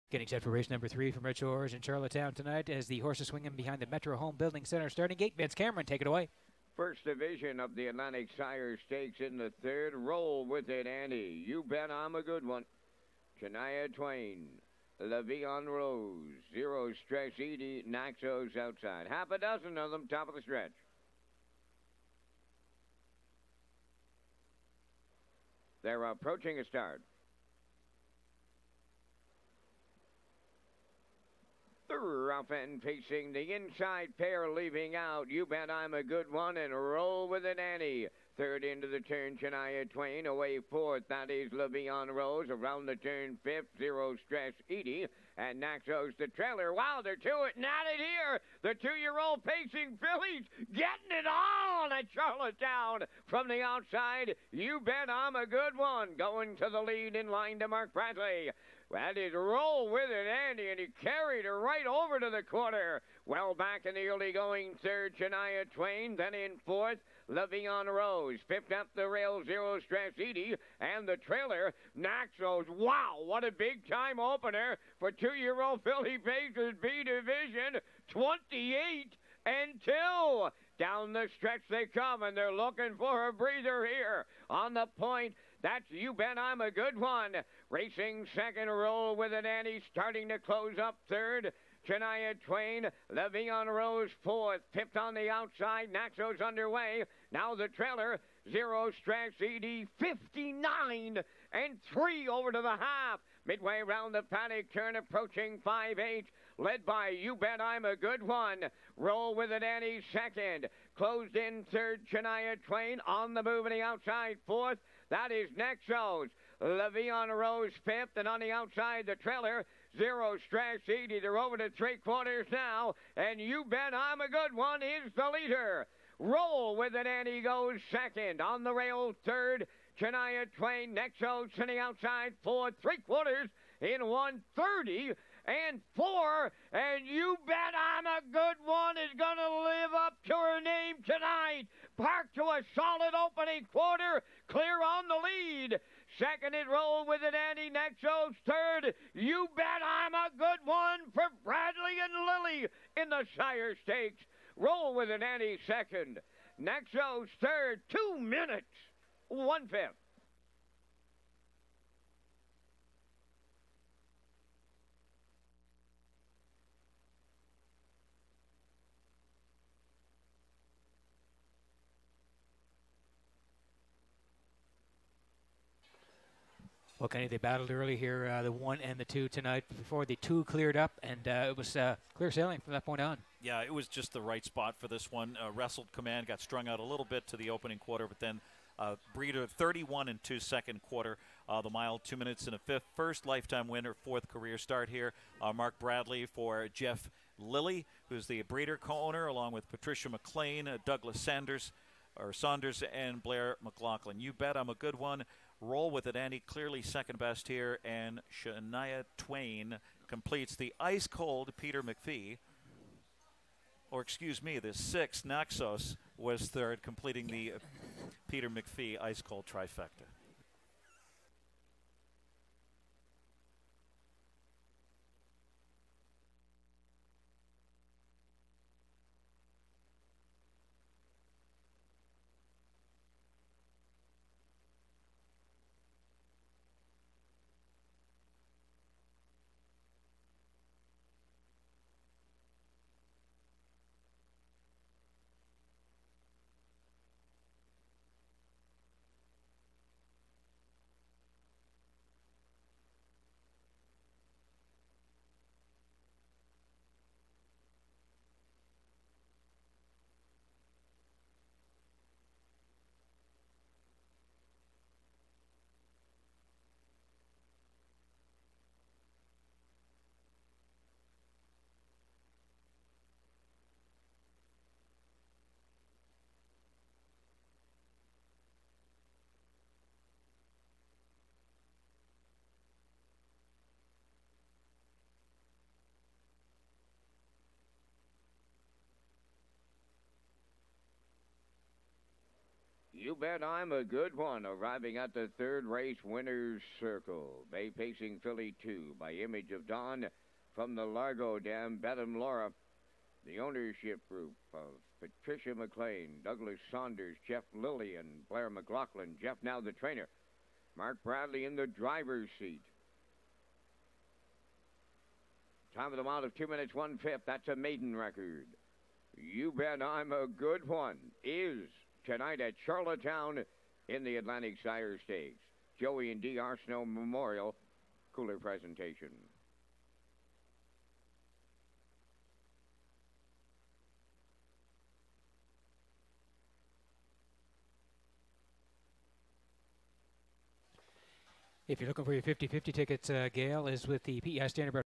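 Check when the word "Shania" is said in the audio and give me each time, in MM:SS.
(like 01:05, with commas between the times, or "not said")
00:13, 00:39, 01:05, 01:31, 01:52, 02:09, 03:28.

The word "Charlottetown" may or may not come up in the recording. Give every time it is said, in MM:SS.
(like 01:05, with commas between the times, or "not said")
00:01, 00:52, 05:22.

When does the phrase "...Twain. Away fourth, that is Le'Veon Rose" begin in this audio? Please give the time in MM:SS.
00:39.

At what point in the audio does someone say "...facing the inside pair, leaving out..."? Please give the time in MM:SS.
00:32.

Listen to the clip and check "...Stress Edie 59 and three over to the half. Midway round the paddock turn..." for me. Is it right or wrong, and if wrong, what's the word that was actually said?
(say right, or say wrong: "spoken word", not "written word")
right.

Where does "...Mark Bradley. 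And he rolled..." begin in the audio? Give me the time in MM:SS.
00:57.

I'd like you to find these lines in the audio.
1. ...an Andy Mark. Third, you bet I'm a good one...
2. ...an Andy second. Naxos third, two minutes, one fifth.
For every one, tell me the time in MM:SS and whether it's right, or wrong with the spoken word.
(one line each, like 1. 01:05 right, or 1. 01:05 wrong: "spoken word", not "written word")
1. 02:27 wrong: "Naxos", not "Mark"
2. 02:35 right.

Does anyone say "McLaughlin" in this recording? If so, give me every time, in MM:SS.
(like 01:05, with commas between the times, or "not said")
03:23, 05:08.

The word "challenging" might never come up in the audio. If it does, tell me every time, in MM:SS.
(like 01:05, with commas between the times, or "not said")
not said.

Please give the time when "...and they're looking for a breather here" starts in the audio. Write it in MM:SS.
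01:22.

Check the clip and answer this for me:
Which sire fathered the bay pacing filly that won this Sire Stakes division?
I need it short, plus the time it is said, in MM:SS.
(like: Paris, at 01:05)
Image of Dawn, at 04:59.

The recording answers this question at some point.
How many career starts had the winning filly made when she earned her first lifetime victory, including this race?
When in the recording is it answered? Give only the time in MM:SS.
03:13.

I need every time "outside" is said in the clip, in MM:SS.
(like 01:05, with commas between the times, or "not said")
00:18, 00:53, 01:35, 01:53, 01:58, 02:11.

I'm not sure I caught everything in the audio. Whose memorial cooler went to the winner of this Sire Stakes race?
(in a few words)
Joey and D. Arsenault.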